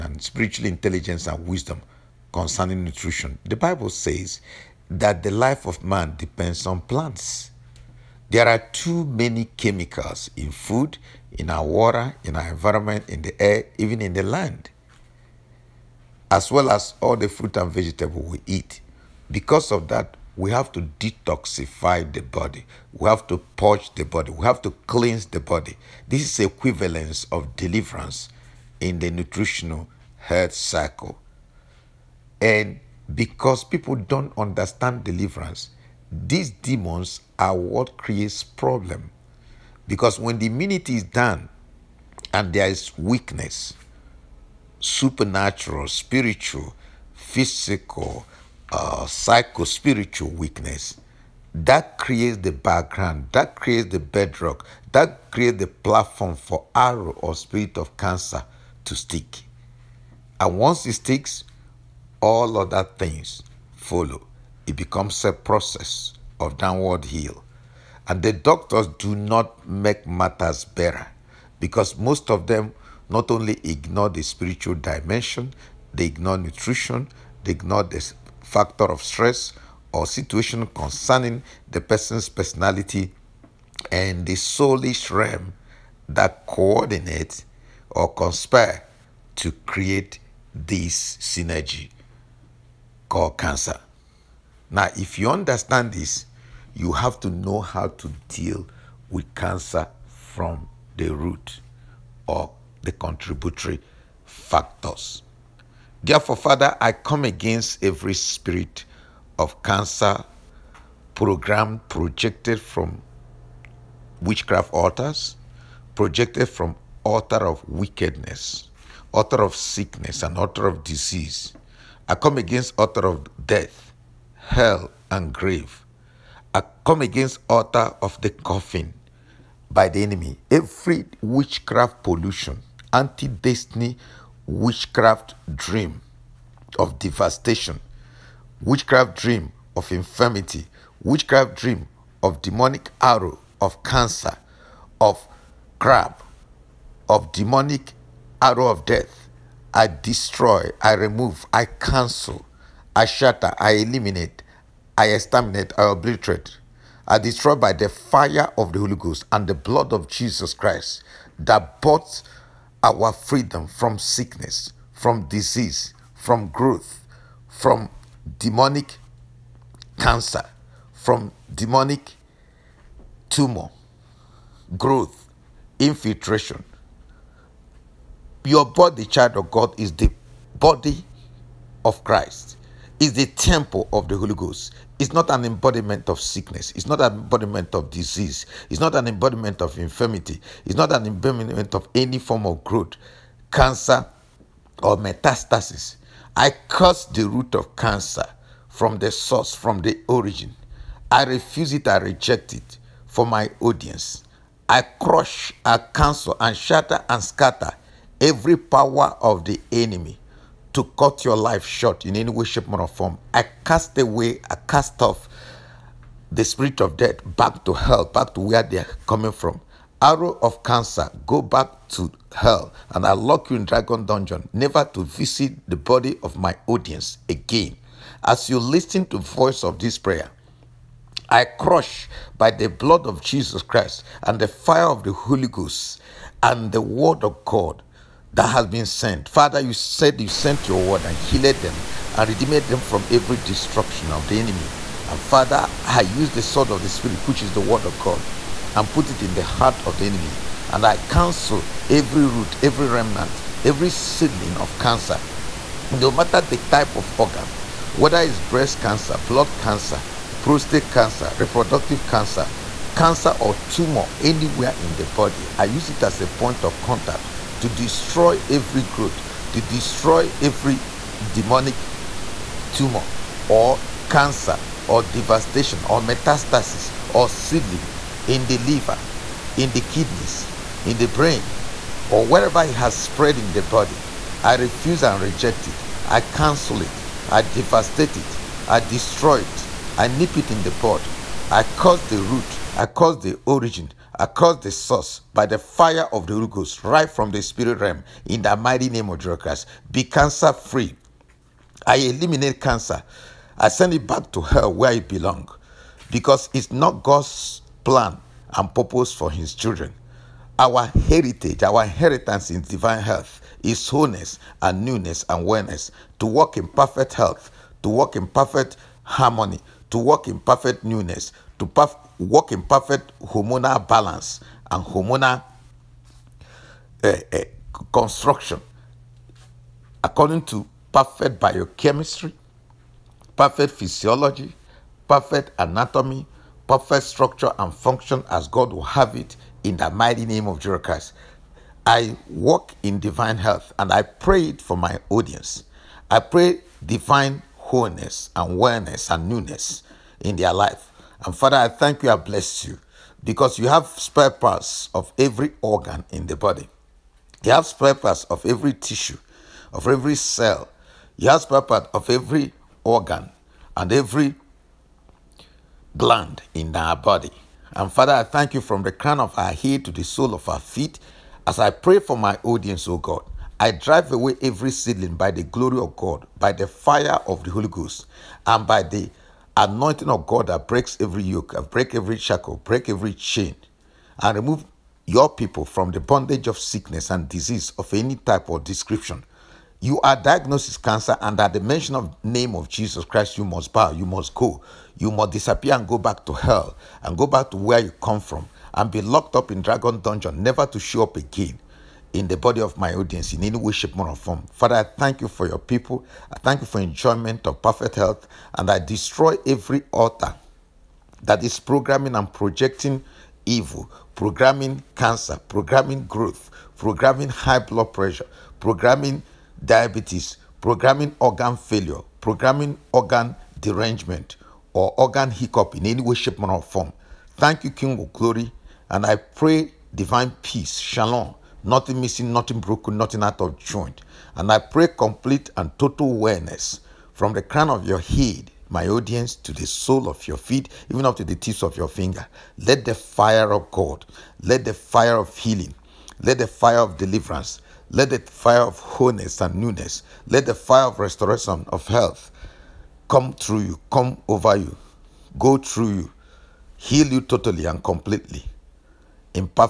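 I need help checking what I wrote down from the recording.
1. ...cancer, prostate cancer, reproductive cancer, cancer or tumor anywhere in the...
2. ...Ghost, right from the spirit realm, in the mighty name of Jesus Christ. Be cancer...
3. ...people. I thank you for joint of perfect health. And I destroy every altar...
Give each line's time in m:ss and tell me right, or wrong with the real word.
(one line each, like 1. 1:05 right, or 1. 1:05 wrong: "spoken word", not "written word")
1. 4:19 right
2. 4:56 right
3. 6:45 wrong: "enjoyment", not "joint".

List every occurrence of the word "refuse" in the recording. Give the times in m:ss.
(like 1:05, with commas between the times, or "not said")
3:21, 4:44.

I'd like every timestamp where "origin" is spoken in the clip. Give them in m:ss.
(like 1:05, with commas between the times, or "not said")
3:20, 4:53.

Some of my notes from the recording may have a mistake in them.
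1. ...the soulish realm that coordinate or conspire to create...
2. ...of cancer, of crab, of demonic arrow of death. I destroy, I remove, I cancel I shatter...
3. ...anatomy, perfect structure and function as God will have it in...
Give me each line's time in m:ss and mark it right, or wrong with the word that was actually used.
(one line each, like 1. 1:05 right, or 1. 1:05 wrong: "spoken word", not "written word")
1. 1:24 right
2. 2:23 right
3. 5:35 right.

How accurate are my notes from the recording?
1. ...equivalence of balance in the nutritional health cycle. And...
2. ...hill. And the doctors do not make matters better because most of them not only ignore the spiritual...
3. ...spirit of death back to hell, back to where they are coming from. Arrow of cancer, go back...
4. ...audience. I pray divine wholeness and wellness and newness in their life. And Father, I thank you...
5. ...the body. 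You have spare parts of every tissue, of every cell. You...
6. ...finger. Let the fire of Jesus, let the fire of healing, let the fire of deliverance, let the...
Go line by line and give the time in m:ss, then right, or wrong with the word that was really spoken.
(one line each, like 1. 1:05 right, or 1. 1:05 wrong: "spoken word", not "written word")
1. 0:26 wrong: "deliverance", not "balance"
2. 1:07 right
3. 3:36 right
4. 5:45 right
5. 5:56 right
6. 7:21 wrong: "God", not "Jesus".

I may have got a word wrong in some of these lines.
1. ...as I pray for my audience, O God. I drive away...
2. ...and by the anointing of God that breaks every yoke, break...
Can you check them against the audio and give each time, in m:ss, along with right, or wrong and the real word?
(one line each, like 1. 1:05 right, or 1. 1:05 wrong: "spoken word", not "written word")
1. 6:11 right
2. 6:18 right.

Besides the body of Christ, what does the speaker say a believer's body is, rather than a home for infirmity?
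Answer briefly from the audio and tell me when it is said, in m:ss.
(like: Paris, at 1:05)
temple of the Holy Ghost, at 3:03.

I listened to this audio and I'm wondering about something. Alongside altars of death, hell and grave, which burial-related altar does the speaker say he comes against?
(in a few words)
altar of the coffin.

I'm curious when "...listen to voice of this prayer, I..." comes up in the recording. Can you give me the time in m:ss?
3:48.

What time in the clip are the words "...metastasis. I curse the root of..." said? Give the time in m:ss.
3:14.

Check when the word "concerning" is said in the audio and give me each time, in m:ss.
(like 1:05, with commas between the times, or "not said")
0:02, 1:20.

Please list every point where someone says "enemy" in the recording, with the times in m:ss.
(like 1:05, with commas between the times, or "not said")
2:10, 3:29, 4:04, 4:10.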